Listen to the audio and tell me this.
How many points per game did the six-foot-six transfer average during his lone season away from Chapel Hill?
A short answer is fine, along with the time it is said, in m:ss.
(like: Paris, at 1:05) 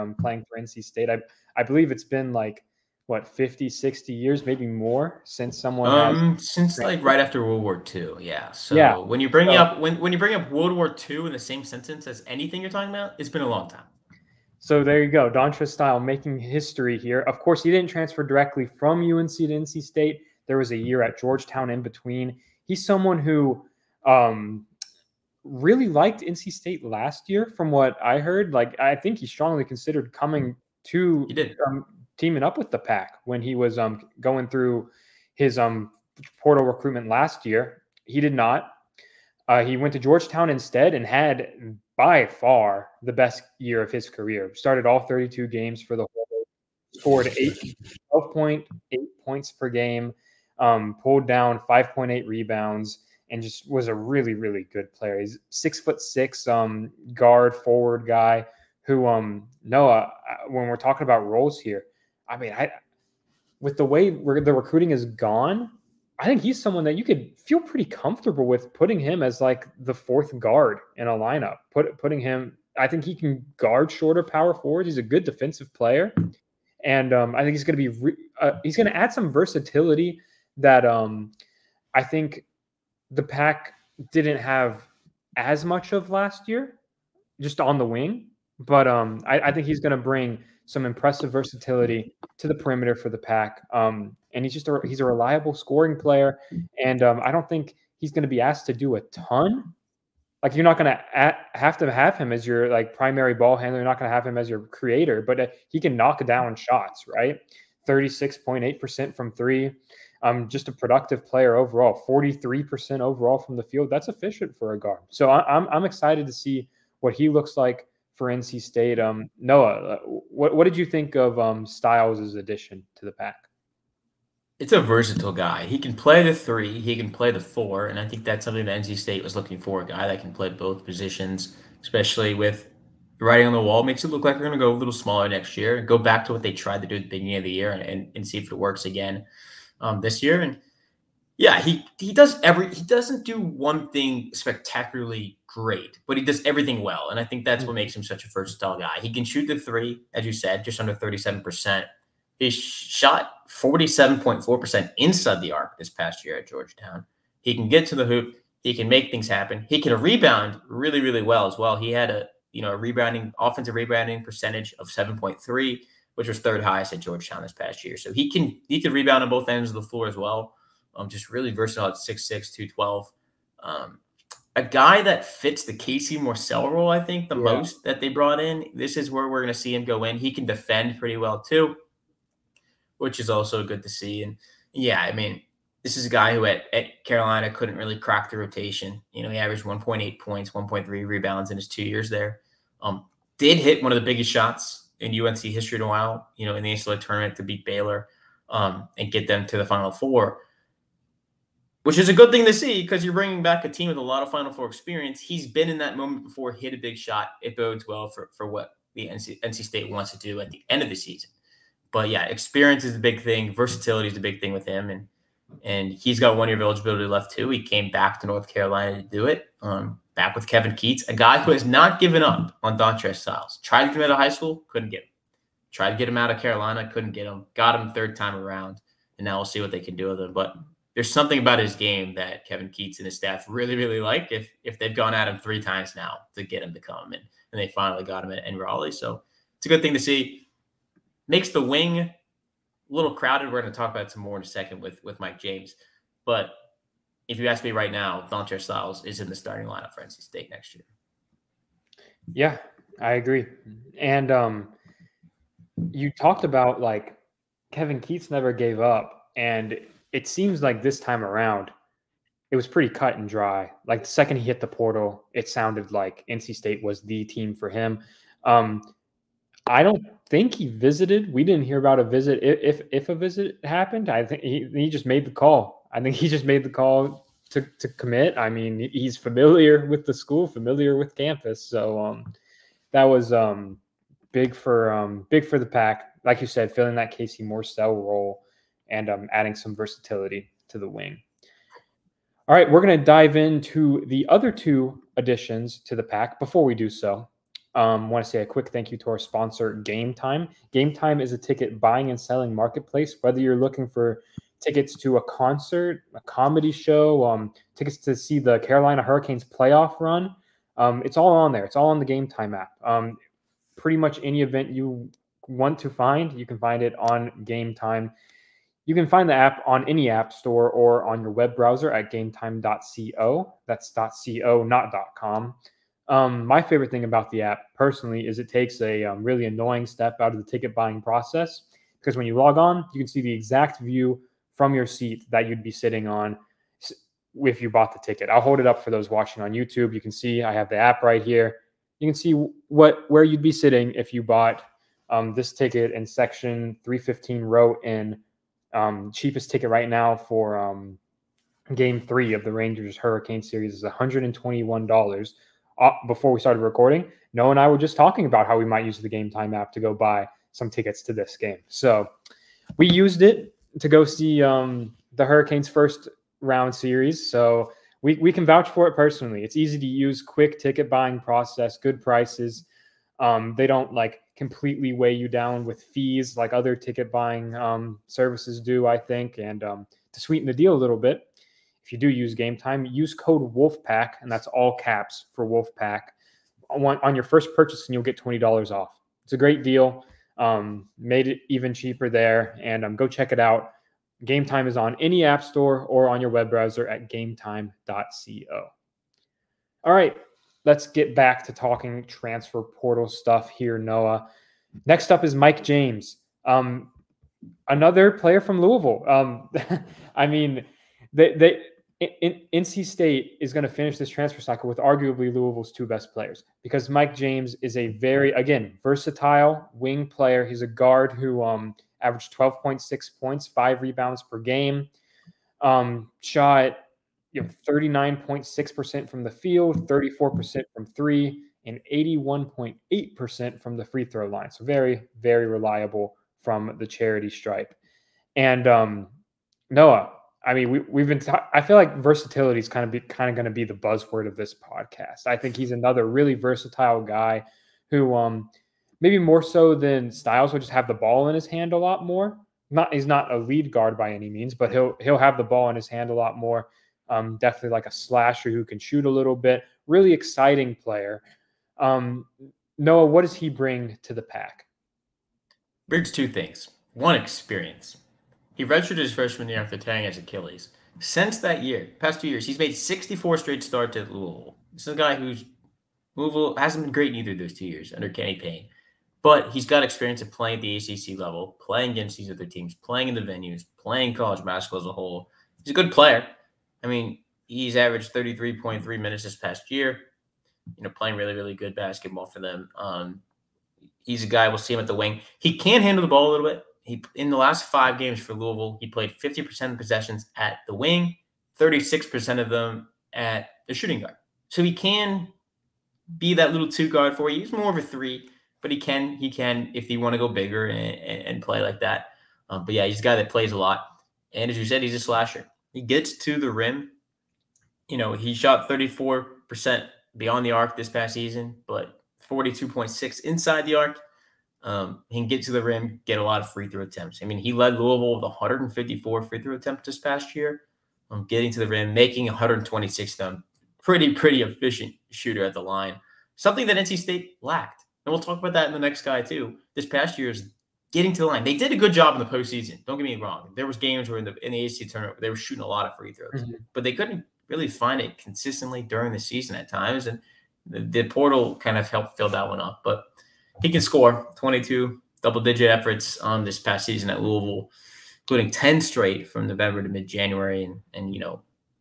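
12.8, at 0:48.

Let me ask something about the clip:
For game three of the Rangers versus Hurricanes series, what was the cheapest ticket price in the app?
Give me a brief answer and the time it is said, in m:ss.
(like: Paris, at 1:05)
$121, at 5:53.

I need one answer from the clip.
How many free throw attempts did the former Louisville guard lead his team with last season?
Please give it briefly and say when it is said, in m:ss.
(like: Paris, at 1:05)
154, at 8:48.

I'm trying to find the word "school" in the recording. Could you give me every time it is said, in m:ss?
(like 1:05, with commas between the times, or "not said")
3:44, 4:40.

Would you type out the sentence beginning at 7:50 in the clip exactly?
Since that year, past two years, he's made 64 straight starts at Louisville.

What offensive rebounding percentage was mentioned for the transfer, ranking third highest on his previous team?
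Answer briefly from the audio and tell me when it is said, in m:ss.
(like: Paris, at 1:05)
7.3, at 2:44.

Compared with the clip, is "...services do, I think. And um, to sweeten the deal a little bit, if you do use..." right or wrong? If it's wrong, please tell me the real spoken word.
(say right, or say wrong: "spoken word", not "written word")
right.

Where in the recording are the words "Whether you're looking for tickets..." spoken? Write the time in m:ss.
5:03.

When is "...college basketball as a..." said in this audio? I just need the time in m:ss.
8:04.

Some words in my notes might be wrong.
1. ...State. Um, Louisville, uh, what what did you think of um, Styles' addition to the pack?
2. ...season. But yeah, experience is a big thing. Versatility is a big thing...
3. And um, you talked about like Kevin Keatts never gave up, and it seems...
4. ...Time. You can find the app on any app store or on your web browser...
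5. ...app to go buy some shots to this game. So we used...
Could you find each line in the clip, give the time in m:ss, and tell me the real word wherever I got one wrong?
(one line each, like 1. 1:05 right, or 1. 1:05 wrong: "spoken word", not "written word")
1. 1:58 wrong: "Noah", not "Louisville"
2. 3:30 right
3. 4:13 right
4. 5:17 right
5. 5:59 wrong: "tickets", not "shots".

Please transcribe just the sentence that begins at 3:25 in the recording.
He's been in that moment before, hit a big shot.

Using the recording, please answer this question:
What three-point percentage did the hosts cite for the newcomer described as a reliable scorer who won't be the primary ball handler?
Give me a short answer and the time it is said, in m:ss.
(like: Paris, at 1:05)
36.8%, at 1:47.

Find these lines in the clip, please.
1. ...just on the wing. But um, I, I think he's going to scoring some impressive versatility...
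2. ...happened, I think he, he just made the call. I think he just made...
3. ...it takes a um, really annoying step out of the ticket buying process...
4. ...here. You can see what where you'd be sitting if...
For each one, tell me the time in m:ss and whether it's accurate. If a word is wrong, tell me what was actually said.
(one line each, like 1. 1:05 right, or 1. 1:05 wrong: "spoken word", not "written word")
1. 1:27 wrong: "bring", not "scoring"
2. 4:33 right
3. 5:28 right
4. 5:41 right.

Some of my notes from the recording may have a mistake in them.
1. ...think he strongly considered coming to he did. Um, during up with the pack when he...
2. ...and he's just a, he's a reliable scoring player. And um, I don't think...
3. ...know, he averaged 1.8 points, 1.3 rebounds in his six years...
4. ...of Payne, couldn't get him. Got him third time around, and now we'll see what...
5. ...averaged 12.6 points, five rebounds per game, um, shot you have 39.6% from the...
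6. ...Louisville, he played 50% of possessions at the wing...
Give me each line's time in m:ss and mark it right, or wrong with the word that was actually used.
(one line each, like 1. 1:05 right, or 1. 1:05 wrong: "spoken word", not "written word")
1. 0:28 wrong: "teaming", not "during"
2. 1:34 right
3. 3:09 wrong: "two", not "six"
4. 3:46 wrong: "Carolina", not "Payne"
5. 7:02 right
6. 8:18 right.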